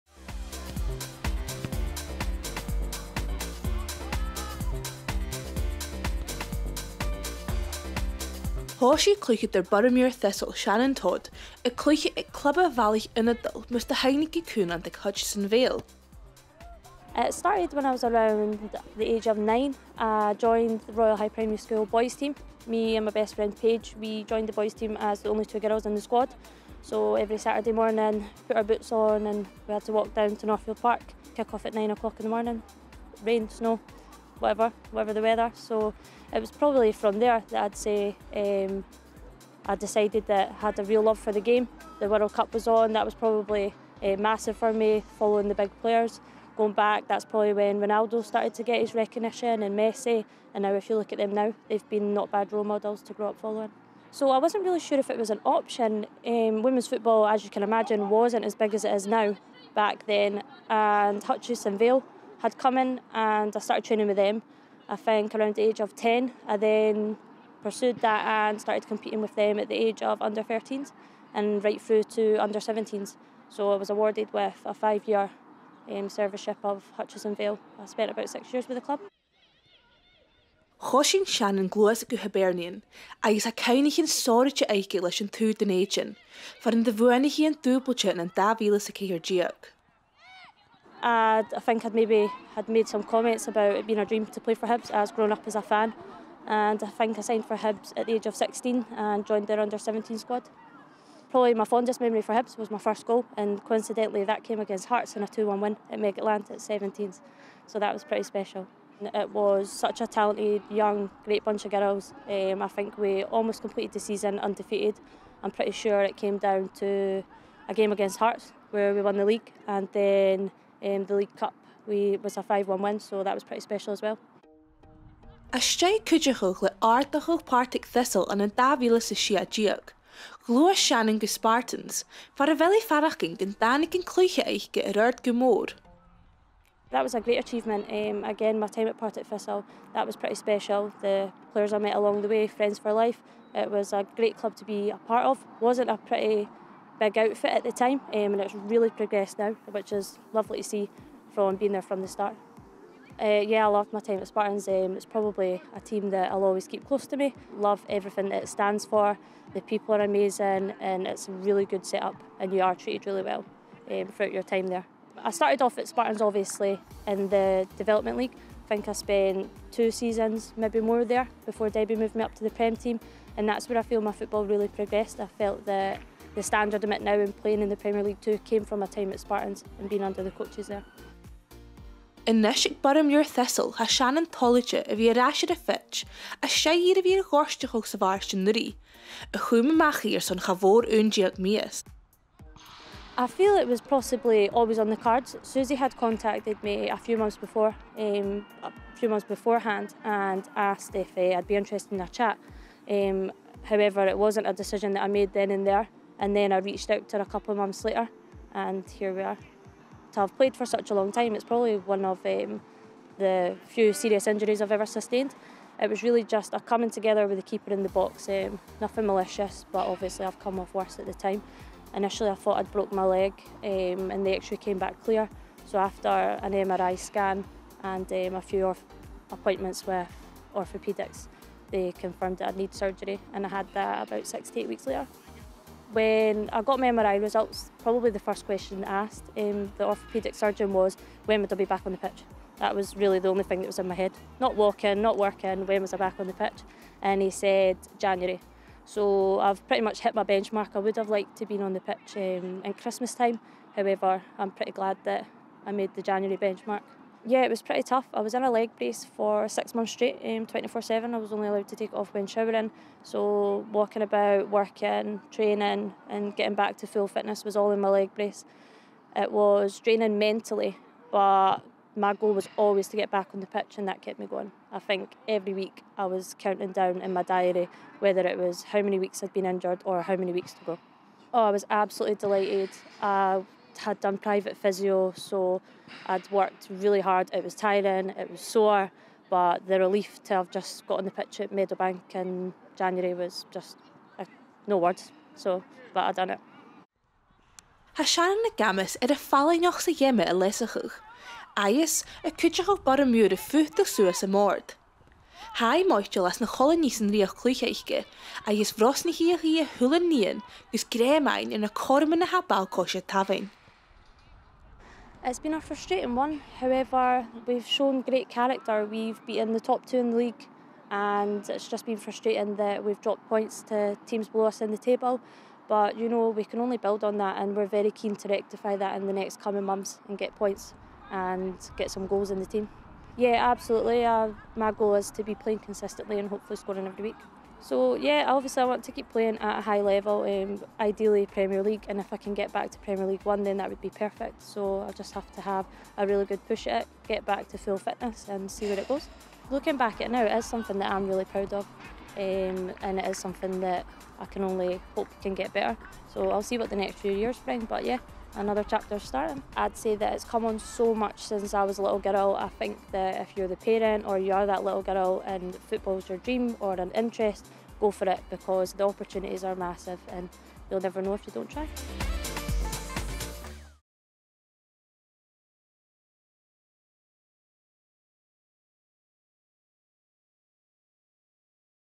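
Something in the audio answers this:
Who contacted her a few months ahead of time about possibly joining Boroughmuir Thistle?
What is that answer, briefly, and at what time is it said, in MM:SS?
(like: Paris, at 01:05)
Susie, at 03:15.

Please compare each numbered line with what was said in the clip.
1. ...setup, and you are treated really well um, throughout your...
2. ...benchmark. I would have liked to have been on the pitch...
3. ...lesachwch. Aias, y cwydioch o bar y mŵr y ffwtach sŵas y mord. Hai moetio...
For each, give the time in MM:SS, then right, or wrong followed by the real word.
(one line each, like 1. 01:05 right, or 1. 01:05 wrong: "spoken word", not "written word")
1. 02:41 right
2. 04:10 right
3. 05:00 right.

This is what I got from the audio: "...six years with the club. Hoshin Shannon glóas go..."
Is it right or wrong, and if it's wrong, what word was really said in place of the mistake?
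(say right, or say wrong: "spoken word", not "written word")
right.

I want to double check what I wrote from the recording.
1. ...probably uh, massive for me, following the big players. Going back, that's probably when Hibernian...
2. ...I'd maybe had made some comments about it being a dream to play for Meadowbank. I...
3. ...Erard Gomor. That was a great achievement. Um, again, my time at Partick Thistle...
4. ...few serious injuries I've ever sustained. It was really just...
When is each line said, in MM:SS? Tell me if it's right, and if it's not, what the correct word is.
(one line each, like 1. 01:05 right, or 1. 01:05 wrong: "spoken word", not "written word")
1. 00:43 wrong: "Ronaldo", not "Hibernian"
2. 01:31 wrong: "Hibs", not "Meadowbank"
3. 02:14 right
4. 03:33 right.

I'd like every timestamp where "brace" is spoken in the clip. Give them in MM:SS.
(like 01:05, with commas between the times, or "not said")
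04:18, 04:28.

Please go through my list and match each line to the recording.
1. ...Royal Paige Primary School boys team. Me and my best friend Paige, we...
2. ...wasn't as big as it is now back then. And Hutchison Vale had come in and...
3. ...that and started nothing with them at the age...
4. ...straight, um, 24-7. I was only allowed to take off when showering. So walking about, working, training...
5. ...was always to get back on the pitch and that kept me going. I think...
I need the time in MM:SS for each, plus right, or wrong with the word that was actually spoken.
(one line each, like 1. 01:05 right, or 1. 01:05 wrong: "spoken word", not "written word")
1. 00:20 wrong: "High", not "Paige"
2. 00:58 right
3. 01:08 wrong: "competing", not "nothing"
4. 04:19 right
5. 04:32 right.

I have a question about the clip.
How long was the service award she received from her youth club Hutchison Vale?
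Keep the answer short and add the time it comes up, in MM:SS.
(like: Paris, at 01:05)
5 years, at 01:14.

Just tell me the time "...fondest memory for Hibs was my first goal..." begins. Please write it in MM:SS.
01:41.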